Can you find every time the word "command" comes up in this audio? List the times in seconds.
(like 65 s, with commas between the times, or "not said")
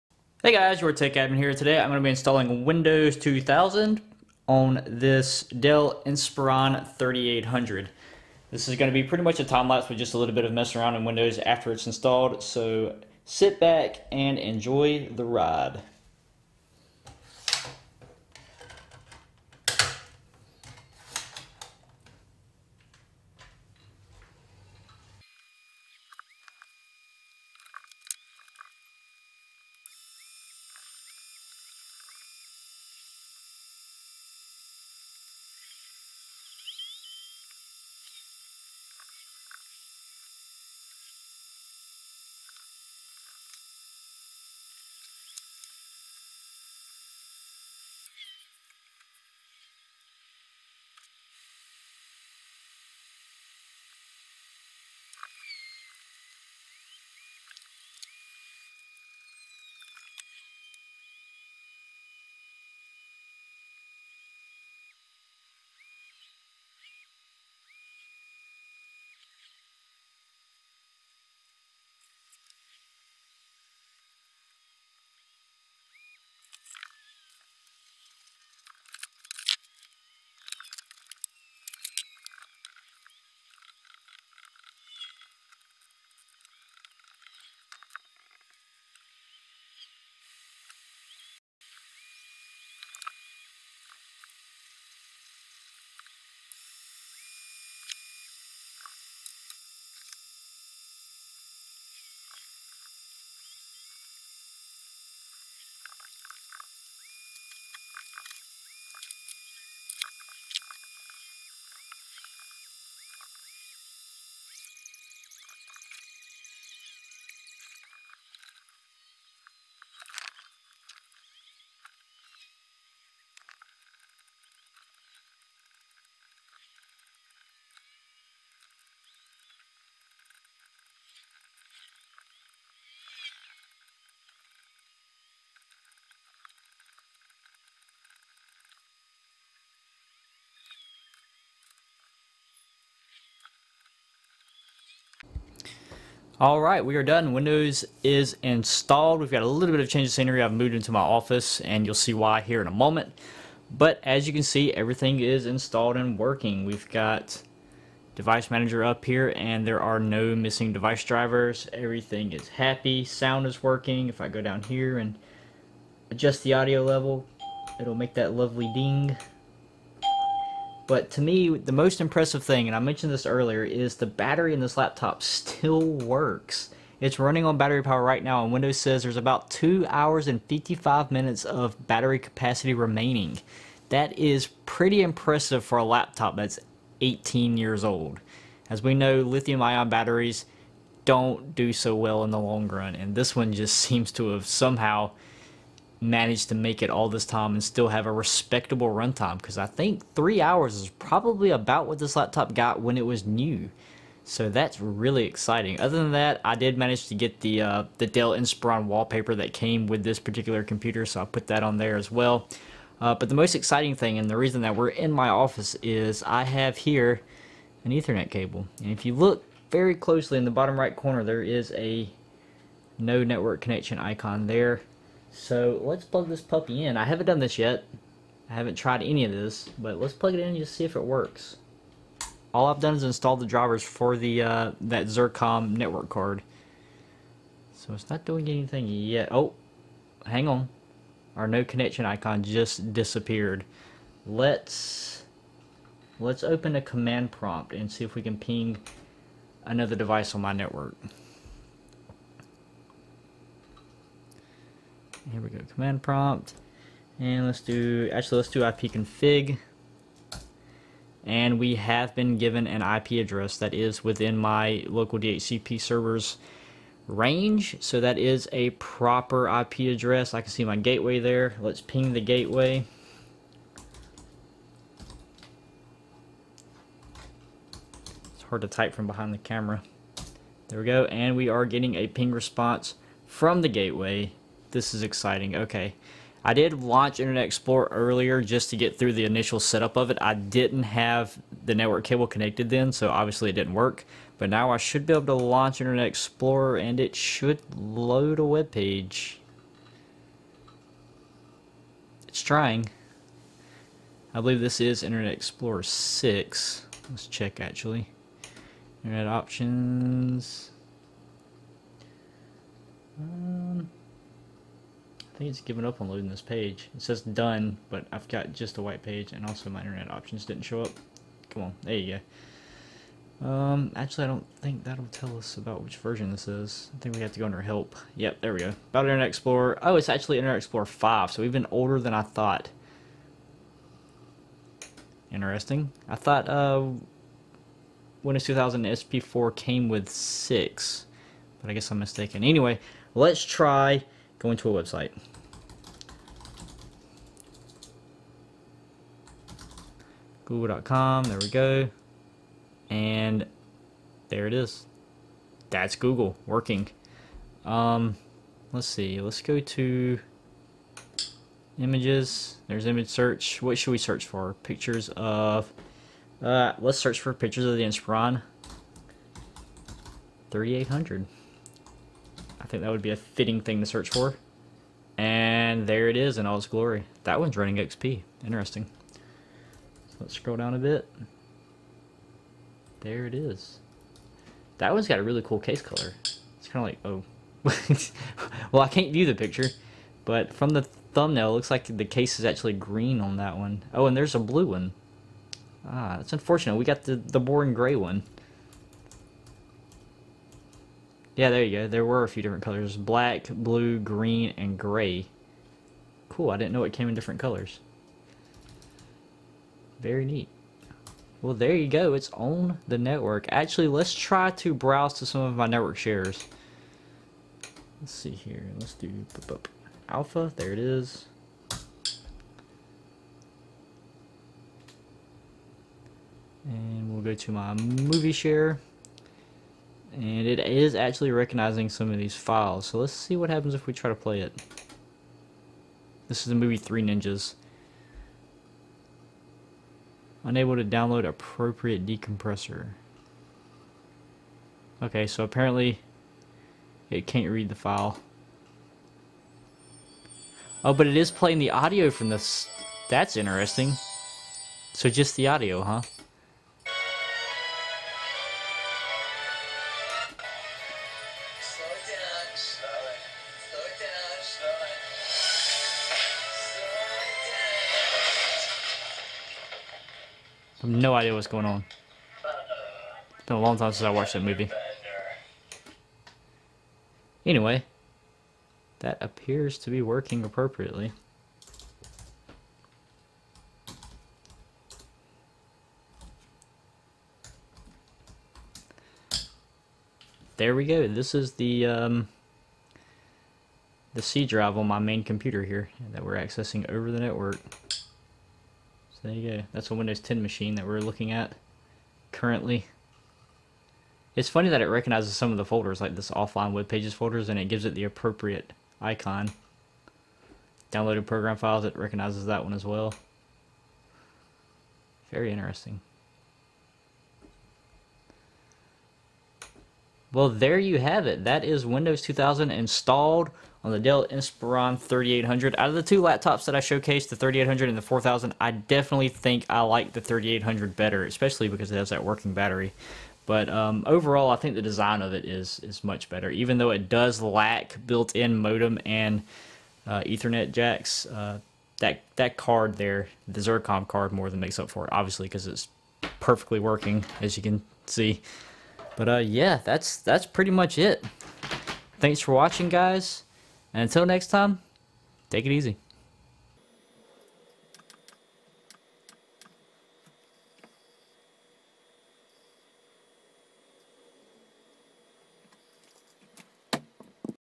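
246 s, 255 s.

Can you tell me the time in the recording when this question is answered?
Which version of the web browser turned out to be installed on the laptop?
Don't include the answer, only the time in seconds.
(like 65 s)
330 s.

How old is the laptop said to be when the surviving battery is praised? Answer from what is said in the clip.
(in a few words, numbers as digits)
18 years.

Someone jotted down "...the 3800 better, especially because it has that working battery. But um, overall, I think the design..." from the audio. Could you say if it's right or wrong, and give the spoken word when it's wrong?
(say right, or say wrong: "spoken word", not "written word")
right.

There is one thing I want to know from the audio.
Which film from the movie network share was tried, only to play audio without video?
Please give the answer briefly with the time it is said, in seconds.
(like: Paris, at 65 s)
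Three Ninjas, at 436 s.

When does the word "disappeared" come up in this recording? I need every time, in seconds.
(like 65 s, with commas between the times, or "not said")
242 s.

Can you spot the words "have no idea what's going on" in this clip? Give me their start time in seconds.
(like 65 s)
470 s.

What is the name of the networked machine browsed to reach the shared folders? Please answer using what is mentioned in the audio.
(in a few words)
alpha.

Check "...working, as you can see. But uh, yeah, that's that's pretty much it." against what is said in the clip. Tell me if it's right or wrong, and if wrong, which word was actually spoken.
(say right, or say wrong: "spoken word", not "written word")
right.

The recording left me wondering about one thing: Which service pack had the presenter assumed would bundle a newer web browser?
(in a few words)
SP4.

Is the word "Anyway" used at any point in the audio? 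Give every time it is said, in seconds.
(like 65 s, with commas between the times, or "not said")
342 s, 477 s.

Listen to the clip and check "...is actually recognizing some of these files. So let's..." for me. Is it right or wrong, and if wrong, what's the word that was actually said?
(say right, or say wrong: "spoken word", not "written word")
right.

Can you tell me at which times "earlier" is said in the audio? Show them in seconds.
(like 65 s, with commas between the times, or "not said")
173 s, 287 s.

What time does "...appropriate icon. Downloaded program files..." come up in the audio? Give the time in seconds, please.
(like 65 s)
508 s.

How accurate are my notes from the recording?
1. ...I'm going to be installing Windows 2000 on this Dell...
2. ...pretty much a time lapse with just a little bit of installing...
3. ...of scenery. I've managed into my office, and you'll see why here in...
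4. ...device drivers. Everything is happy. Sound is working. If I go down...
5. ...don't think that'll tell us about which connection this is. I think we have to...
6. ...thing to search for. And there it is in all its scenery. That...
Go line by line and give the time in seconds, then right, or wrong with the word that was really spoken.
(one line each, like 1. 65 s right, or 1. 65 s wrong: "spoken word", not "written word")
1. 1 s right
2. 9 s wrong: "messing", not "installing"
3. 150 s wrong: "moved", not "managed"
4. 160 s right
5. 324 s wrong: "version", not "connection"
6. 373 s wrong: "glory", not "scenery".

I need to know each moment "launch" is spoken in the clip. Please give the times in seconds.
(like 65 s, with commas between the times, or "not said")
286 s, 295 s.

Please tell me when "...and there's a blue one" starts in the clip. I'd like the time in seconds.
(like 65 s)
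394 s.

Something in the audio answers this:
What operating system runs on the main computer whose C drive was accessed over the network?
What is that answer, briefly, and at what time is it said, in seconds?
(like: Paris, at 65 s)
Windows 10, at 499 s.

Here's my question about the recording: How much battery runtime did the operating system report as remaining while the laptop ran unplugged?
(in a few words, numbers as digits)
2 hours and 55 minutes.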